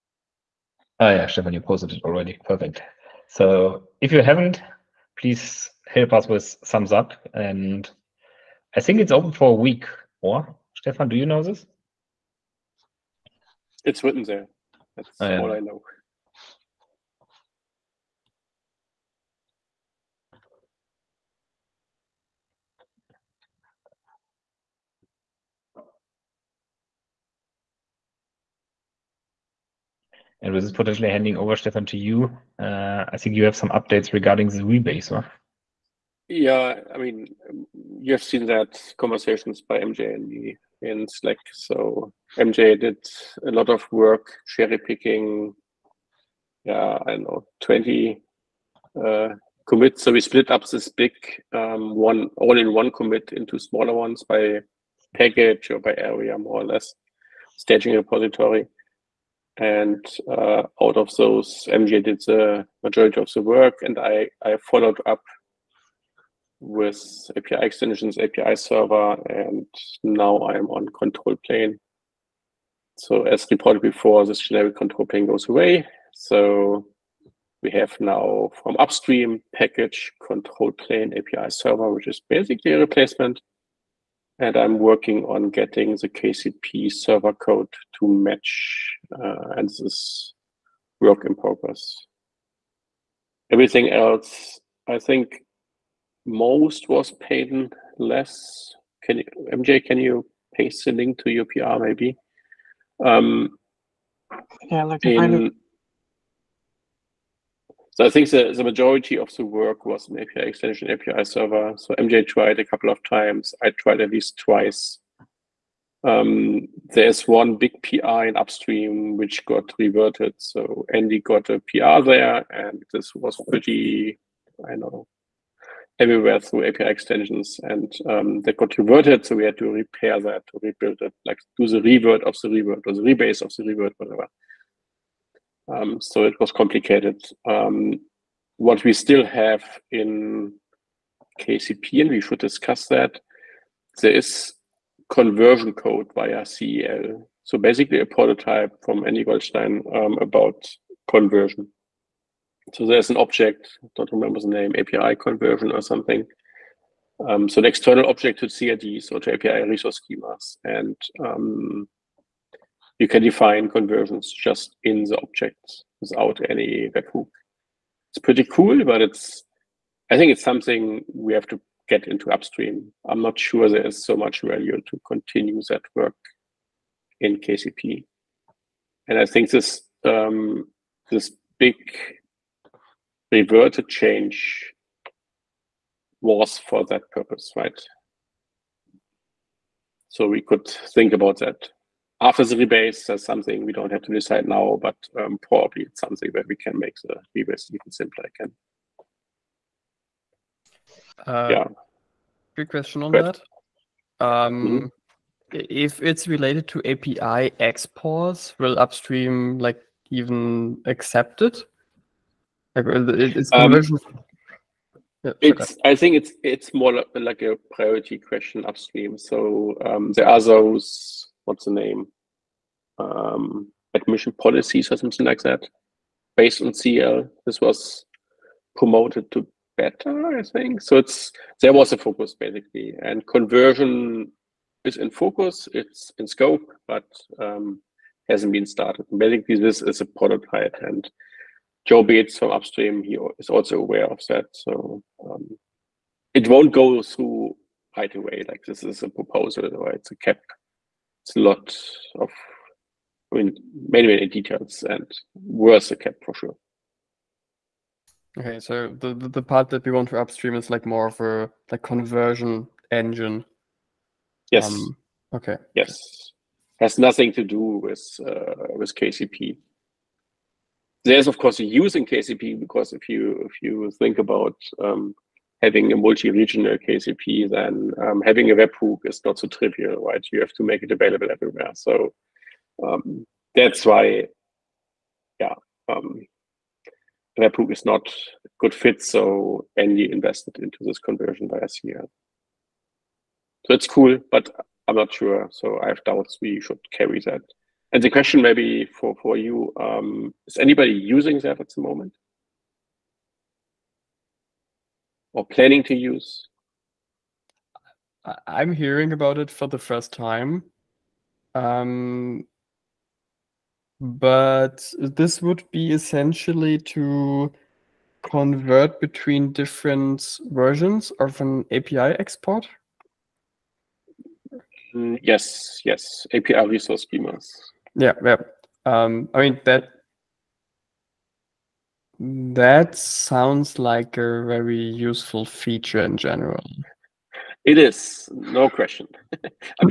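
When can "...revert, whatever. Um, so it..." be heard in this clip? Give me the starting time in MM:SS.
02:13.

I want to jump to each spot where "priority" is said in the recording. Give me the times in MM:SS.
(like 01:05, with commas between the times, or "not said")
03:37.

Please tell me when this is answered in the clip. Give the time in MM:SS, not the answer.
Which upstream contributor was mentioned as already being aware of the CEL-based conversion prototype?
04:01.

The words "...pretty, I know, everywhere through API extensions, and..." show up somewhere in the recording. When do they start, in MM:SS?
02:03.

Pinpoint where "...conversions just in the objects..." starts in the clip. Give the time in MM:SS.
02:43.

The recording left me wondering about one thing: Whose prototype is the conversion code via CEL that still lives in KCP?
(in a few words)
Andy Goldstein.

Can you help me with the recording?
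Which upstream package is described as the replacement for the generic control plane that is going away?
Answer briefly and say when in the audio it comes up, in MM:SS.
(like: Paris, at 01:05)
control plane api server, at 01:20.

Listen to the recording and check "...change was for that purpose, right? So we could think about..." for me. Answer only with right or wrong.
right.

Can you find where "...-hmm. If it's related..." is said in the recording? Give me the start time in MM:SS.
03:24.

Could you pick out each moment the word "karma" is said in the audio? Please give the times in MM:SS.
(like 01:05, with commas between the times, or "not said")
not said.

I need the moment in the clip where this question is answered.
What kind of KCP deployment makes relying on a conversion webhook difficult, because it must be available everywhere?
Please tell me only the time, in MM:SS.
04:35.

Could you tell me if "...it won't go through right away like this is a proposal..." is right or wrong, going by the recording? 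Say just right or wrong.
right.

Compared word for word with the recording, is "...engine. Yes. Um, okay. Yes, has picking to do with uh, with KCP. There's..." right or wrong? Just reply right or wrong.
wrong.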